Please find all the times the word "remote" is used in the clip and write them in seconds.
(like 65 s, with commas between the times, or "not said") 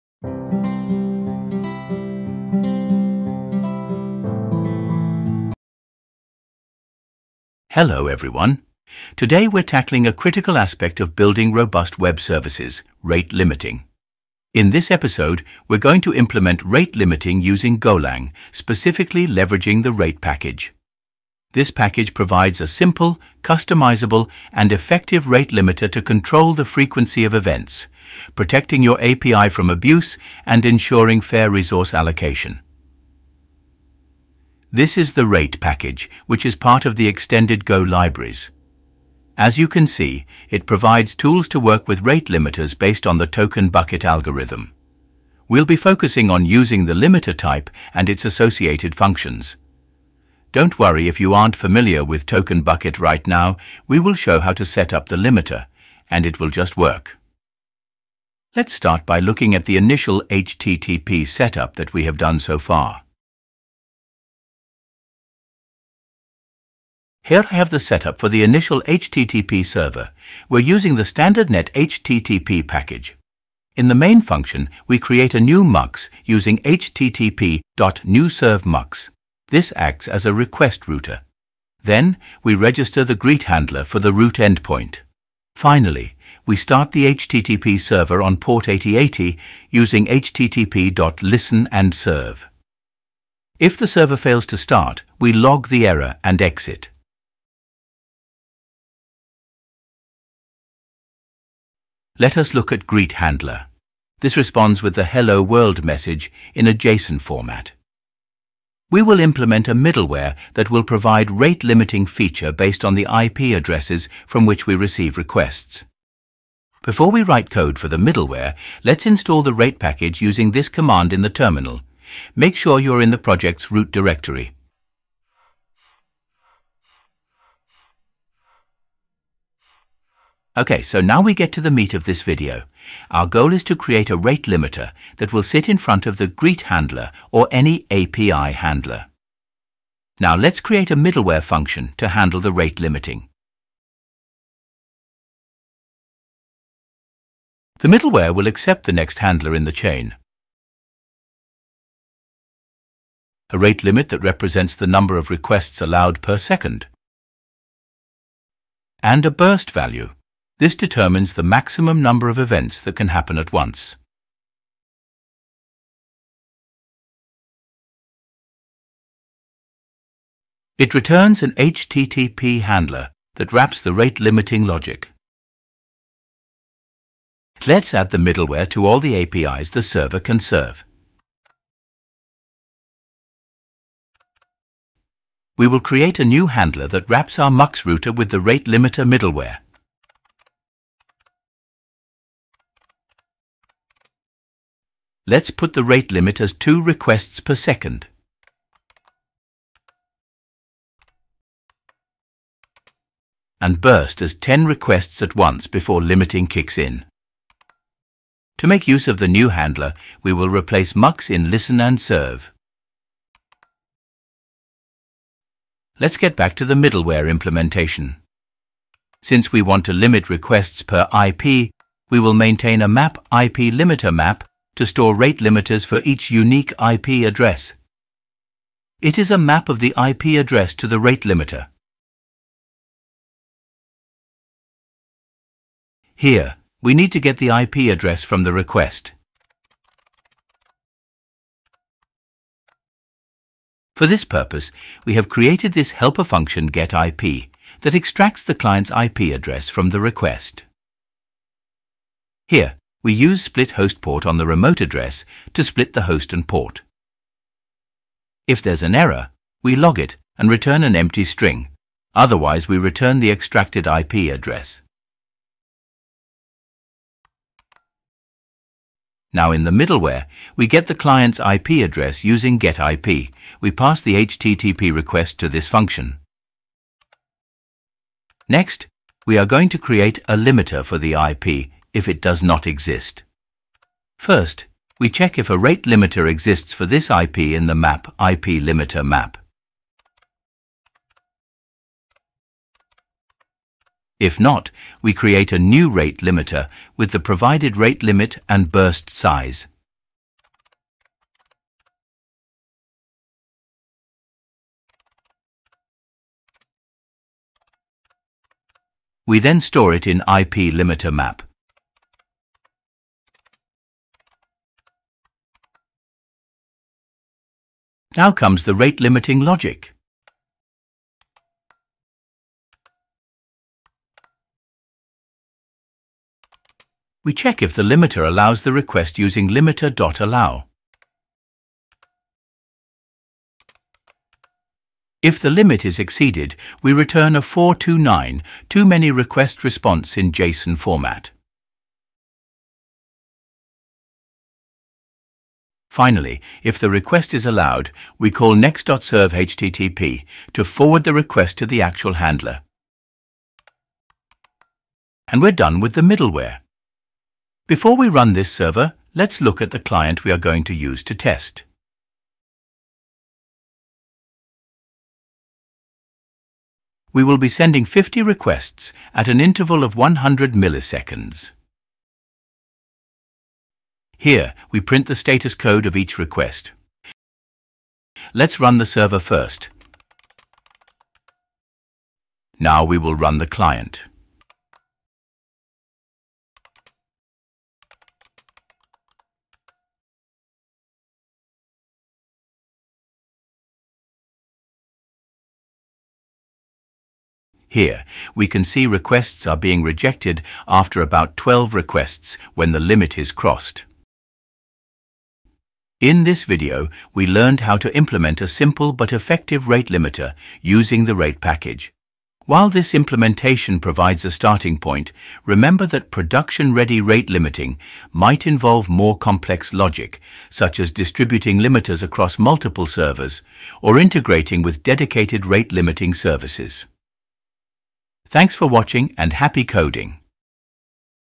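254 s.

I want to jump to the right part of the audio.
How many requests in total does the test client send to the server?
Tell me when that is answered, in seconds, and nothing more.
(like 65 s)
367 s.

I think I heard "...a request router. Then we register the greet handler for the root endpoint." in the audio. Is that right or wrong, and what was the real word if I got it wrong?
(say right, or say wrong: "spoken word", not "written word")
right.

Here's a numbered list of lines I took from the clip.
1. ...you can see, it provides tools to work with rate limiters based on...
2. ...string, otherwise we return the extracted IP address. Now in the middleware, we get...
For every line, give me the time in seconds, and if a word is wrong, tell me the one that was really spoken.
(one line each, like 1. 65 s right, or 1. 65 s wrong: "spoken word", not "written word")
1. 39 s right
2. 261 s right.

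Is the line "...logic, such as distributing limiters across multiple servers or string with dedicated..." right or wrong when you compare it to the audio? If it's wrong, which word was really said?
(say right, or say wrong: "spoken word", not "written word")
wrong: "integrating", not "string".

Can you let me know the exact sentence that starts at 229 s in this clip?
It is a map of the IP address to the rate limiter.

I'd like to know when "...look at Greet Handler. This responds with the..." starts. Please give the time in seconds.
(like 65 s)
102 s.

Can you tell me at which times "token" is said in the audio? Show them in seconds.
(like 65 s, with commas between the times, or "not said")
43 s, 52 s.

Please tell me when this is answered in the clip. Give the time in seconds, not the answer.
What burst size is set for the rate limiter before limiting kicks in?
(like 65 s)
204 s.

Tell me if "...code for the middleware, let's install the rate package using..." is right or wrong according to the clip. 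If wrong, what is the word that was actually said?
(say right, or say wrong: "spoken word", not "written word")
right.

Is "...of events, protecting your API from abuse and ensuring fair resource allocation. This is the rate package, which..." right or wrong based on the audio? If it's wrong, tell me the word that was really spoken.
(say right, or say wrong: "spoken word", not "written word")
right.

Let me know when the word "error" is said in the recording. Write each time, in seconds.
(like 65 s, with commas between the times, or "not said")
95 s, 258 s.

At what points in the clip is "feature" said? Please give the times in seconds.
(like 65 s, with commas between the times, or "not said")
112 s.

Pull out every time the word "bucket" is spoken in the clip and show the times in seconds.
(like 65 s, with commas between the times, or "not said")
43 s, 52 s.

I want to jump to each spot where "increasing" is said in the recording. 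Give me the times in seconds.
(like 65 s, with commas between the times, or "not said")
not said.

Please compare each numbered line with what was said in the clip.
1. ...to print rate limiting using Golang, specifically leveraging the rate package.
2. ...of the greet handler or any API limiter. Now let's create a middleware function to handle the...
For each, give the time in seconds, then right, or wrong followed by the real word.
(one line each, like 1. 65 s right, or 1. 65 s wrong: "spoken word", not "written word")
1. 16 s wrong: "implement", not "print"
2. 136 s wrong: "handler", not "limiter".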